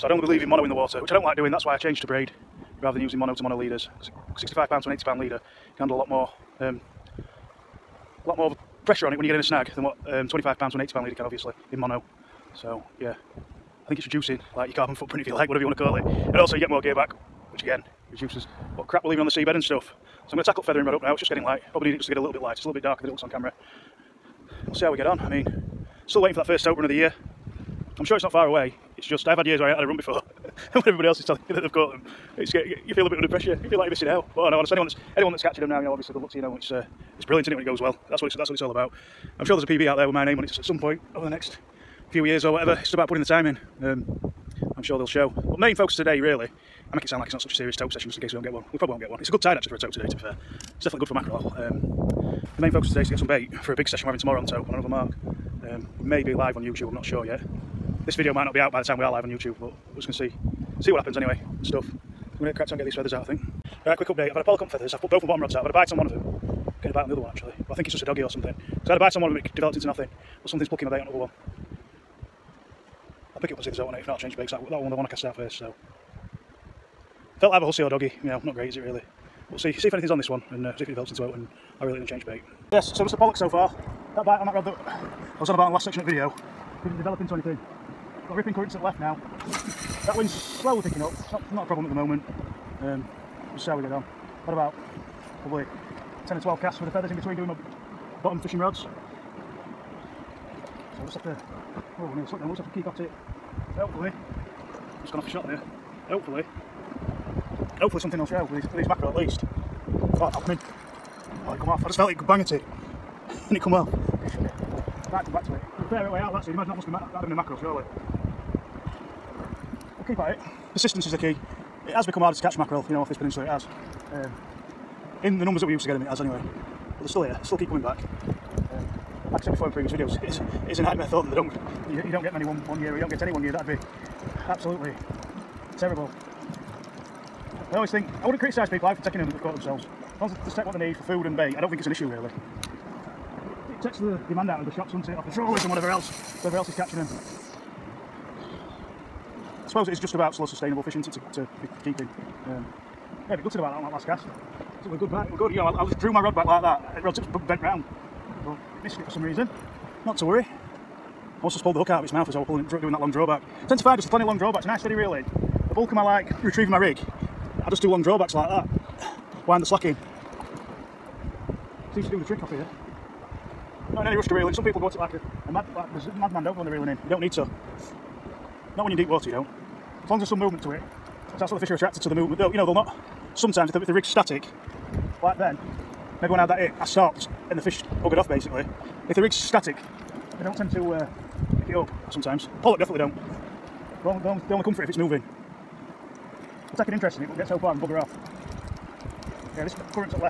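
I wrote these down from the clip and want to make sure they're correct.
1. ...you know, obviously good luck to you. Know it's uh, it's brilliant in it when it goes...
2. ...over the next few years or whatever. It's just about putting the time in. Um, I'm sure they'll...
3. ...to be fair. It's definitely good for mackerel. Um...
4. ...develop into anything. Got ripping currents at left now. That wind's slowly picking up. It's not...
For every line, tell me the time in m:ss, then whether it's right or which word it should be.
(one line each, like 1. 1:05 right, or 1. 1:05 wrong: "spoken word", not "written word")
1. 0:35 right
2. 0:41 right
3. 0:50 right
4. 1:26 right.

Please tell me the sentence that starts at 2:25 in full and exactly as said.
Off the trawlers and whatever else, whatever else is catching them.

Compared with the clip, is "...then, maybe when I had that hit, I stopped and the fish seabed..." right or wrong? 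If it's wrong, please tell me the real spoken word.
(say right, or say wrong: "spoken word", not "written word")
wrong: "buggered", not "seabed".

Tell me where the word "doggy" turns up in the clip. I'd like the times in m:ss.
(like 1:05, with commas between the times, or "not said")
1:08, 1:17.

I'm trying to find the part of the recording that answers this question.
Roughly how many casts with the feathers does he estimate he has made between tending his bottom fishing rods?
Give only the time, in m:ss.
1:36.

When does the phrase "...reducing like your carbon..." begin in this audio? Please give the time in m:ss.
0:14.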